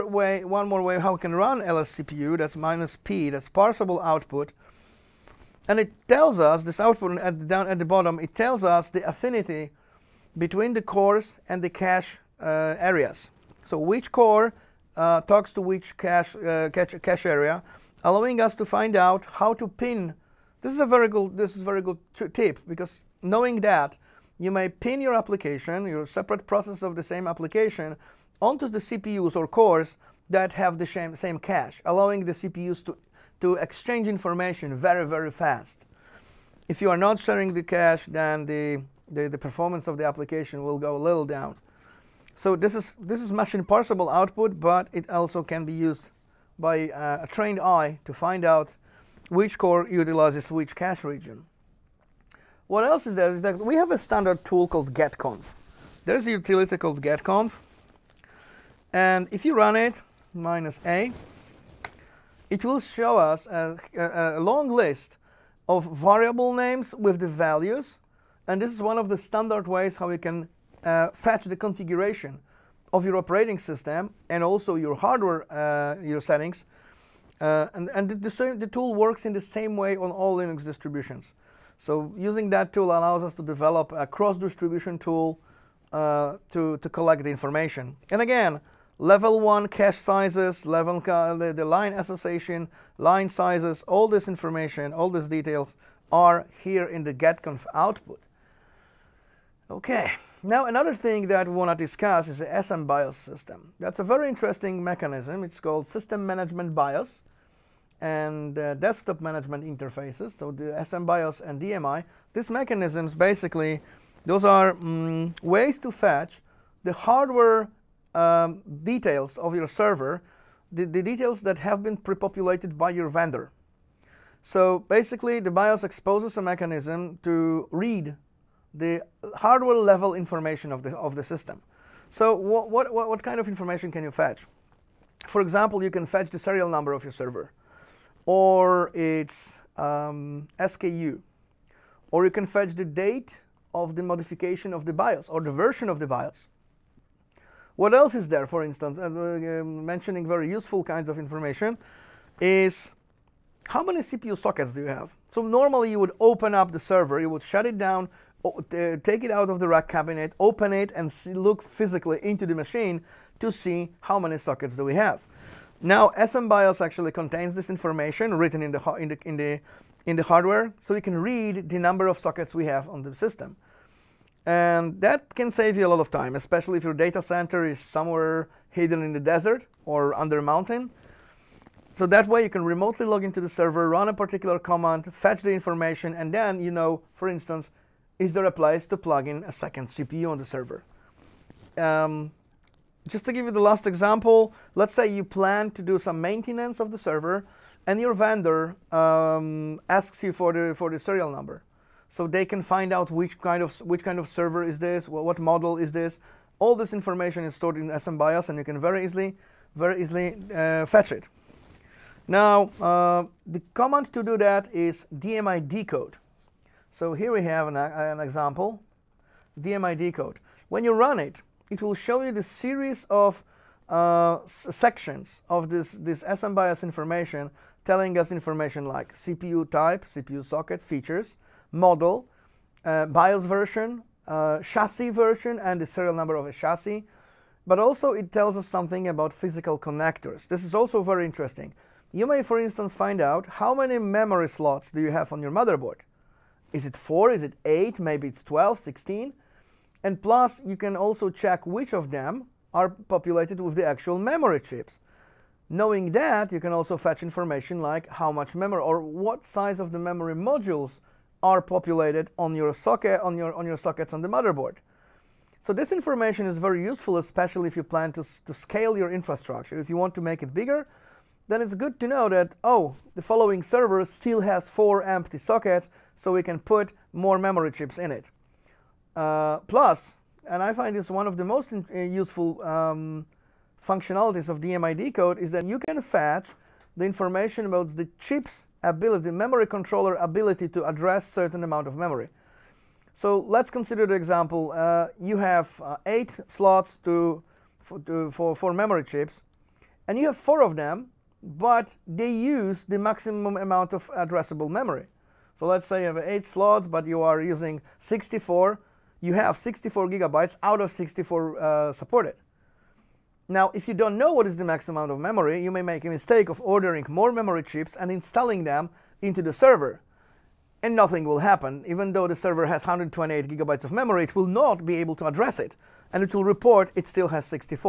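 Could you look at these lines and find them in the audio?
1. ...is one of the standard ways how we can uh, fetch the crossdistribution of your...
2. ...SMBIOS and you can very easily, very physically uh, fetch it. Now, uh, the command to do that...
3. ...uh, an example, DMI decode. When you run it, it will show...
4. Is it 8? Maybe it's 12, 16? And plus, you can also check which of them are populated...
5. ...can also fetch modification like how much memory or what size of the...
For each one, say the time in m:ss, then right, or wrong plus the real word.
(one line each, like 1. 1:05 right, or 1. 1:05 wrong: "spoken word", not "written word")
1. 1:08 wrong: "configuration", not "crossdistribution"
2. 3:27 wrong: "easily", not "physically"
3. 3:37 right
4. 4:07 right
5. 4:16 wrong: "information", not "modification".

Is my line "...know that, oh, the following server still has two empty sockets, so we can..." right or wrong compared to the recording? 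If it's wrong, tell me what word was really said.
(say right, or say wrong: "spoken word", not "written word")
wrong: "four", not "two".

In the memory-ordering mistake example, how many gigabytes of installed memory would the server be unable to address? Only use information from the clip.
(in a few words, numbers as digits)
128 GB.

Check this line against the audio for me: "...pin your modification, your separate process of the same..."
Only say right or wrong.
wrong.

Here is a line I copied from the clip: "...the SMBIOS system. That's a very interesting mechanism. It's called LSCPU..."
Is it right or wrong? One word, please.
wrong.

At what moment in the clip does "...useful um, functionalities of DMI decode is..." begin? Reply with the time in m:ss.
4:41.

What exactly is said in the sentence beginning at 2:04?
So basically, the BIOS exposes a mechanism to read the hardware level information of the, of the system.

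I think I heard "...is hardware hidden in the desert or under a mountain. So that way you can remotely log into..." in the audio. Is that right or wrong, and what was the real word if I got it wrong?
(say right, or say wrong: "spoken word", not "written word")
wrong: "somewhere", not "hardware".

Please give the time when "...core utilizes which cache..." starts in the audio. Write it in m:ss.
0:49.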